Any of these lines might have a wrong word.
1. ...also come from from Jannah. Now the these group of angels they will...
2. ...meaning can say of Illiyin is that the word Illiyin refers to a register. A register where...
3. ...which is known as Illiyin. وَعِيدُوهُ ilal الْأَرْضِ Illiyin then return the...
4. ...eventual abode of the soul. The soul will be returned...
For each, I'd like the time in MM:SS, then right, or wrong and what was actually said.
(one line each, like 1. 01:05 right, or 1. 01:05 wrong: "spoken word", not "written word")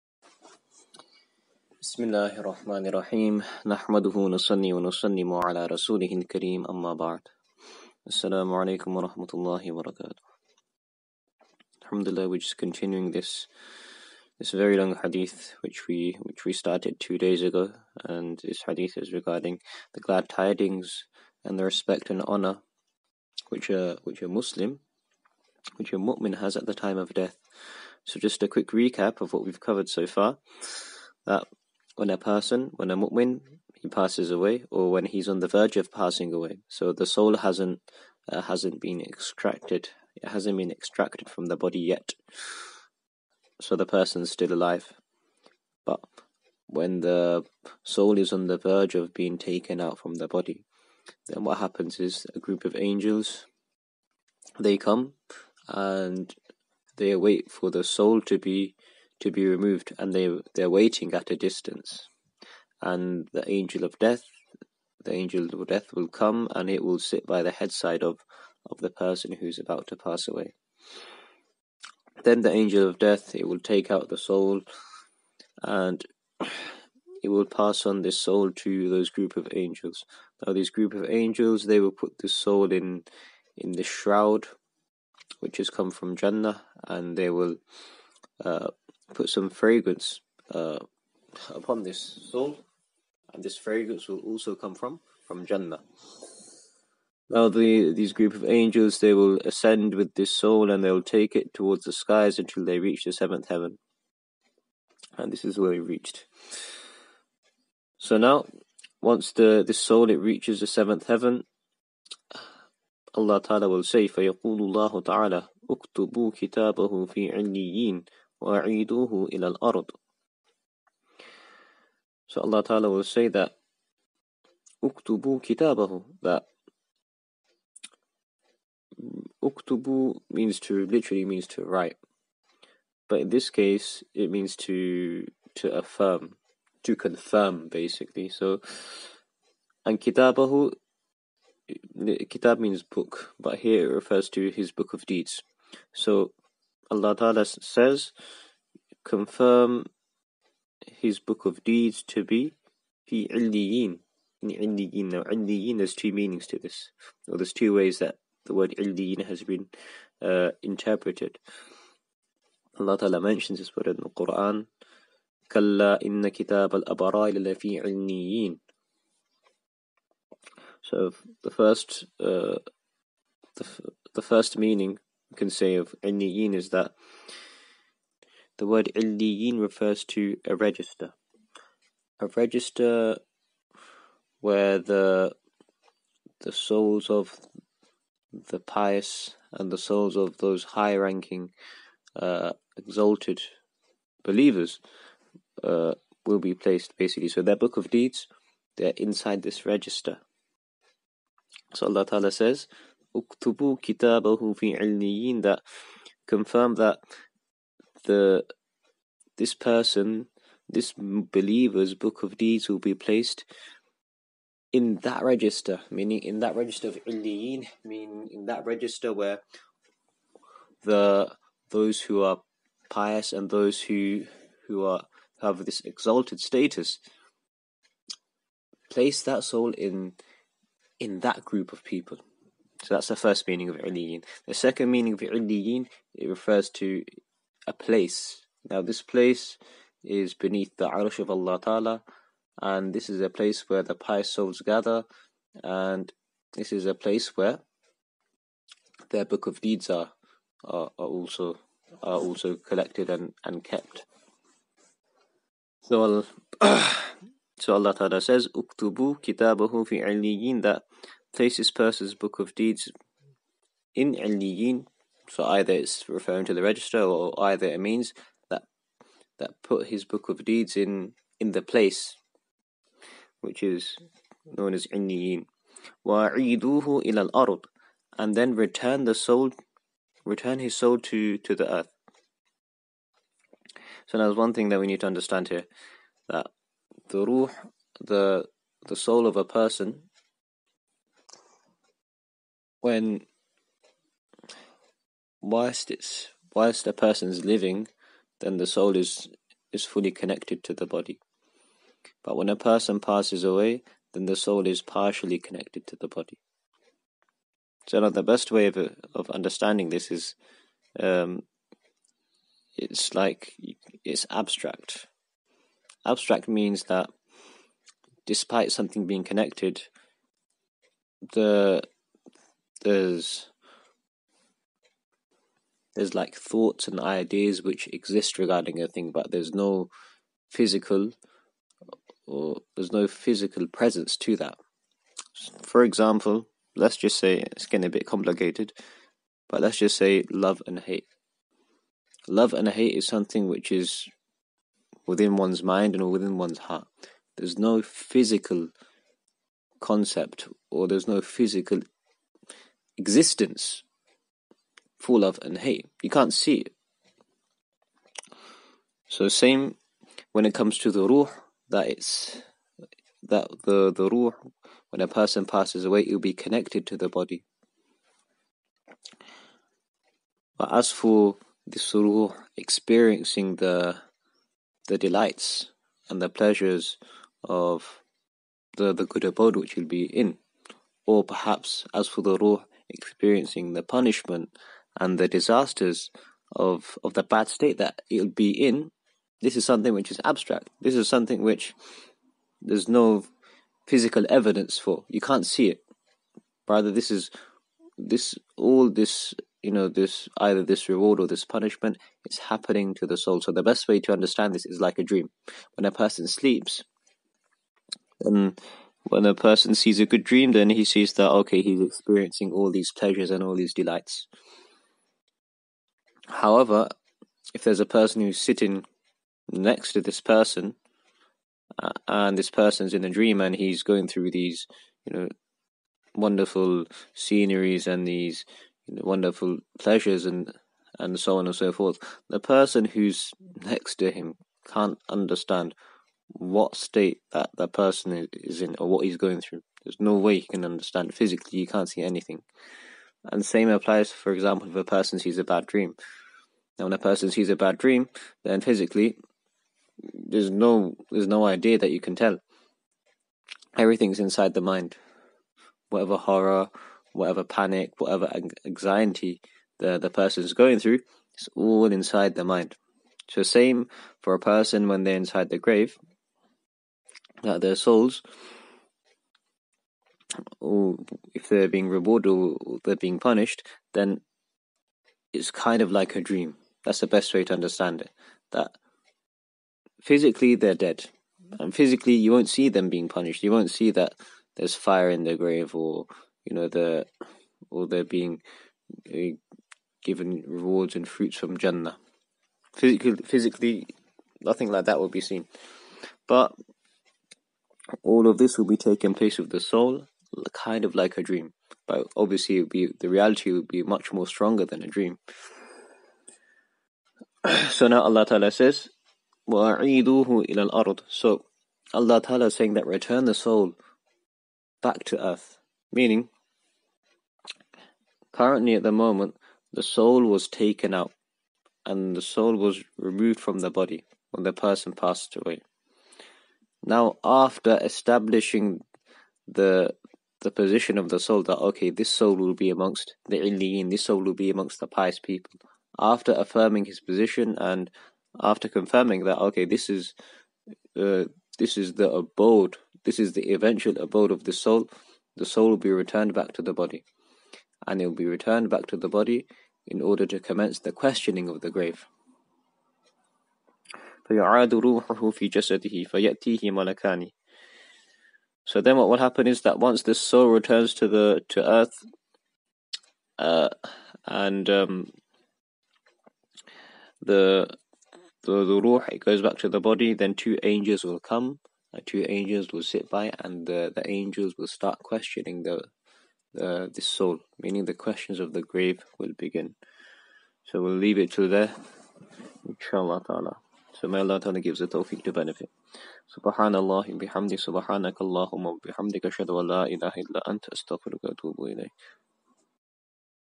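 1. 01:34 right
2. 02:54 right
3. 04:33 wrong: "And", not "Illiyin"
4. 09:03 right.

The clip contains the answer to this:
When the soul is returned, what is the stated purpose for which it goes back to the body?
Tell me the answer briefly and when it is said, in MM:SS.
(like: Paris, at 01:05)
Questioning of the grave, at 09:10.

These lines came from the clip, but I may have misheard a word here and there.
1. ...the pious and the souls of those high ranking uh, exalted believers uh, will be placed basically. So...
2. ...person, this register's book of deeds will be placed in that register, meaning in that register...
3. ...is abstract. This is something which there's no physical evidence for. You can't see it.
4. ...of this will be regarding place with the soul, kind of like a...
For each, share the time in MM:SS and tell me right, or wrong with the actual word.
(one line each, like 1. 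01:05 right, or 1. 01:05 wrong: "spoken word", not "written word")
1. 03:08 right
2. 03:29 wrong: "believer", not "register"
3. 06:30 right
4. 08:18 wrong: "taking", not "regarding".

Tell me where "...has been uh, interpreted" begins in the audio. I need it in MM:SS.
02:39.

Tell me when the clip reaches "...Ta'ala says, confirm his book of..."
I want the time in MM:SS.
02:27.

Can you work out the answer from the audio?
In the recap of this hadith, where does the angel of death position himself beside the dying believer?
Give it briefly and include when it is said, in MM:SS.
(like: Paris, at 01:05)
By the headside, at 01:07.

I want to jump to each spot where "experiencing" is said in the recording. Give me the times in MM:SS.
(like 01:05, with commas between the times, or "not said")
06:12, 06:22, 06:51.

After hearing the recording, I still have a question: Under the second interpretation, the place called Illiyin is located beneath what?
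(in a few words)
The Arsh of Allah.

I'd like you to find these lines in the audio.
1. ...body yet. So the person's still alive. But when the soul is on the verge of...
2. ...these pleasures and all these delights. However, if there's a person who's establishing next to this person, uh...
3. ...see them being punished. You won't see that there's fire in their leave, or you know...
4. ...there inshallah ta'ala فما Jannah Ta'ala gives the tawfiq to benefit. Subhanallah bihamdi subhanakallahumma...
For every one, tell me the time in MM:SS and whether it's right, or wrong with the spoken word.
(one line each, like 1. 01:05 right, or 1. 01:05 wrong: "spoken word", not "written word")
1. 00:41 right
2. 06:52 wrong: "sitting", not "establishing"
3. 08:02 wrong: "grave", not "leave"
4. 09:41 wrong: "Allah", not "Jannah".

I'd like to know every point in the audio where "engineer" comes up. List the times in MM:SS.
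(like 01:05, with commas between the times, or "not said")
not said.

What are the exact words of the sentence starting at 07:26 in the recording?
Now, when a person sees a bad dream, then physically, there's no there's no idea that you can tell.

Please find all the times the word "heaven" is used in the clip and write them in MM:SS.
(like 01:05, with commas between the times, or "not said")
01:43, 01:51.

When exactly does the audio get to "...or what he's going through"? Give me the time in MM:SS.
07:18.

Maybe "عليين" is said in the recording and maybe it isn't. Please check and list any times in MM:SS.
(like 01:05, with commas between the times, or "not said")
01:57, 02:47.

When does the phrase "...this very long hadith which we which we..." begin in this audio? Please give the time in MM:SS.
00:14.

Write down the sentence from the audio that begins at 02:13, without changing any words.
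But in this case it means to to affirm, to confirm basically.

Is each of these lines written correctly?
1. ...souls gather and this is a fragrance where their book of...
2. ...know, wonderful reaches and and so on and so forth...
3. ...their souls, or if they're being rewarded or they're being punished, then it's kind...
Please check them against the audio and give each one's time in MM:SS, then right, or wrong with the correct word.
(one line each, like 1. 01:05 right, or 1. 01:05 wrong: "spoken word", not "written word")
1. 04:04 wrong: "place", not "fragrance"
2. 07:08 wrong: "pleasures", not "reaches"
3. 07:47 right.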